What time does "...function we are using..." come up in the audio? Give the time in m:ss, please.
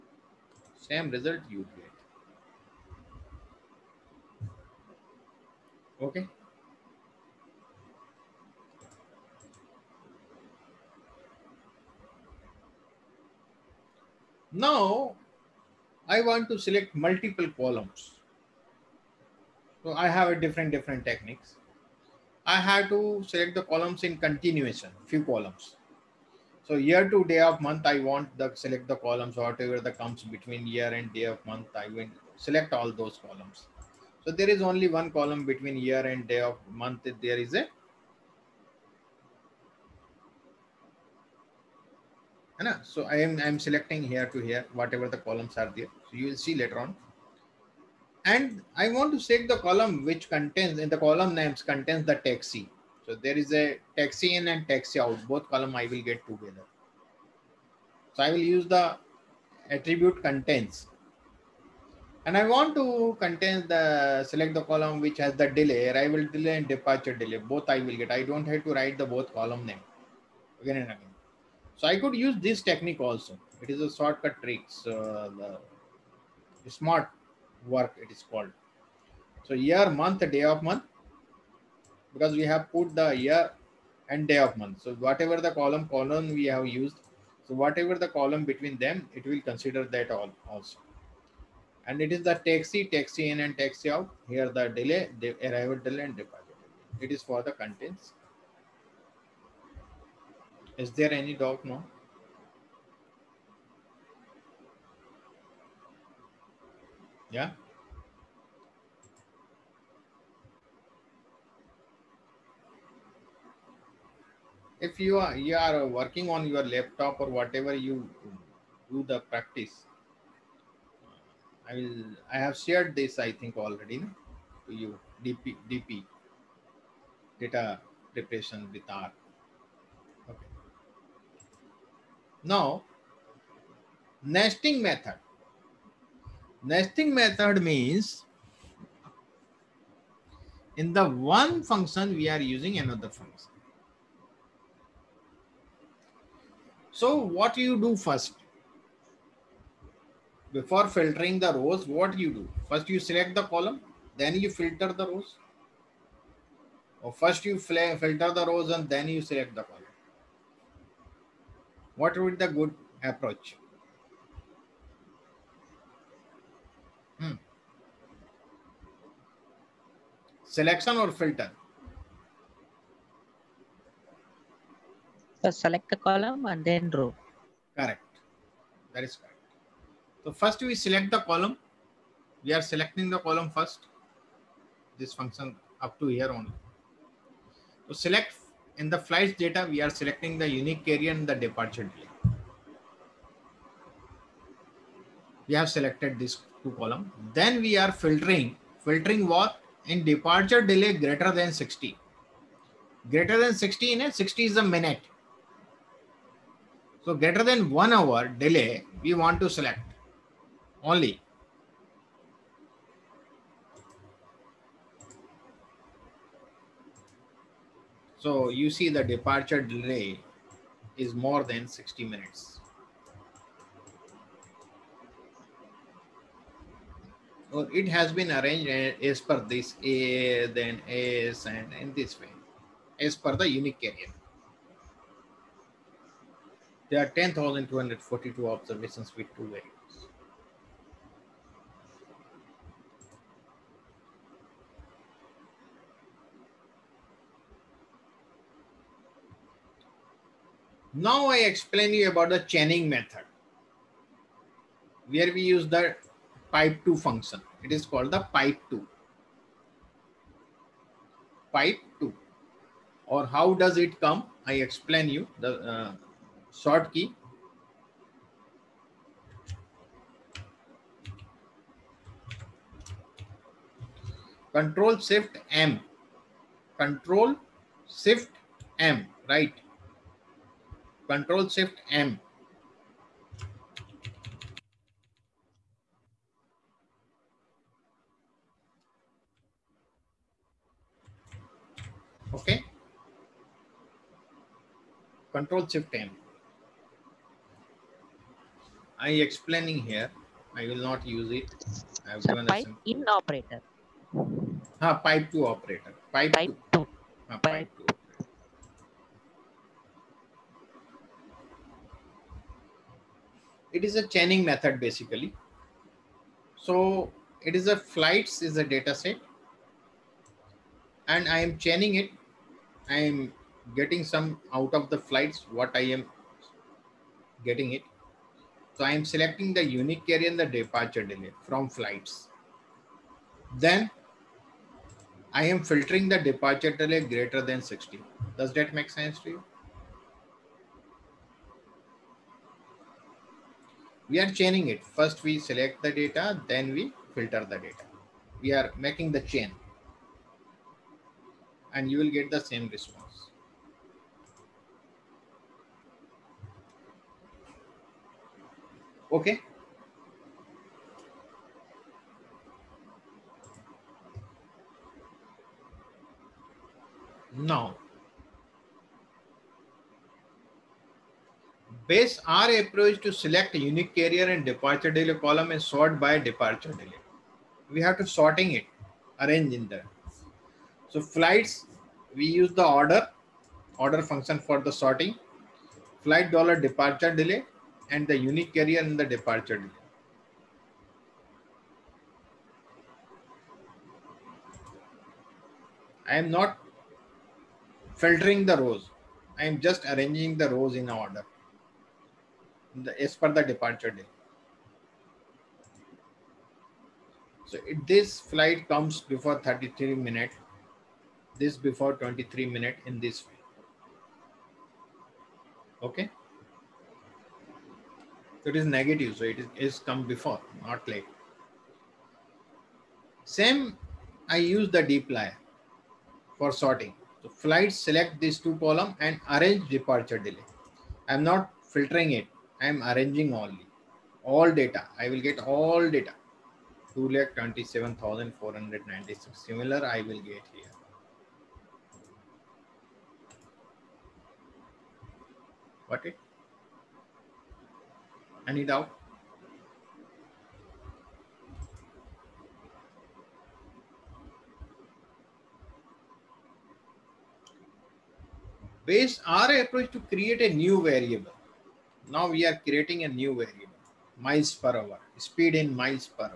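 2:21.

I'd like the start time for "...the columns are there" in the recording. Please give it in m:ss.
0:45.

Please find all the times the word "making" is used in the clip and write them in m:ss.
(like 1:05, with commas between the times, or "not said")
5:48.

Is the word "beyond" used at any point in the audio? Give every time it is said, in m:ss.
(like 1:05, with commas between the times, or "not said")
not said.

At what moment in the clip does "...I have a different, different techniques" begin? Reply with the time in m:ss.
0:19.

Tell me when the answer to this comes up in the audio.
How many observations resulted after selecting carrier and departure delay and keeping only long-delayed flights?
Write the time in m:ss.
3:57.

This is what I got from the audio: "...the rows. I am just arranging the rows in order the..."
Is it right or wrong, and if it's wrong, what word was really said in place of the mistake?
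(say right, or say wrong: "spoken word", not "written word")
right.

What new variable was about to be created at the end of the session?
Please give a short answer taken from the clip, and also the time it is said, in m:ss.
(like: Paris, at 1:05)
miles per hour, at 7:44.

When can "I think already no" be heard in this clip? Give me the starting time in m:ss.
2:03.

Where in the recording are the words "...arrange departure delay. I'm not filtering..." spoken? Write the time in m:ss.
7:09.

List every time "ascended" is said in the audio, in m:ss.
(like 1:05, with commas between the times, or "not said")
not said.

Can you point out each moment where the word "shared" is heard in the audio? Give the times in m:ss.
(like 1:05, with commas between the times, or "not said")
2:02.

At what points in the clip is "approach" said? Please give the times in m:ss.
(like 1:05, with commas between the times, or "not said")
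2:43, 6:12, 7:39.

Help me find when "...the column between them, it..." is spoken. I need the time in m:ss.
1:27.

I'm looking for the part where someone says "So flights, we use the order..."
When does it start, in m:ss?
6:20.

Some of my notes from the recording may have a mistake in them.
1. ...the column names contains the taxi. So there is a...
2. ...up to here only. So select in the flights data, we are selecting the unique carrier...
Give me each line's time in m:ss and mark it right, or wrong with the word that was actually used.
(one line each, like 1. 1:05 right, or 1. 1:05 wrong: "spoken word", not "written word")
1. 0:50 right
2. 3:05 right.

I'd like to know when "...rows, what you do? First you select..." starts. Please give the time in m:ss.
2:31.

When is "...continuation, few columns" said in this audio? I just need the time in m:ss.
0:24.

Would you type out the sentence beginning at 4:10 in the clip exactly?
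Now I explain you about the chaining method where we use the pipe 2 function.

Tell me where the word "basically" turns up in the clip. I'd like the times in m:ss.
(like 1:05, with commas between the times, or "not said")
5:14.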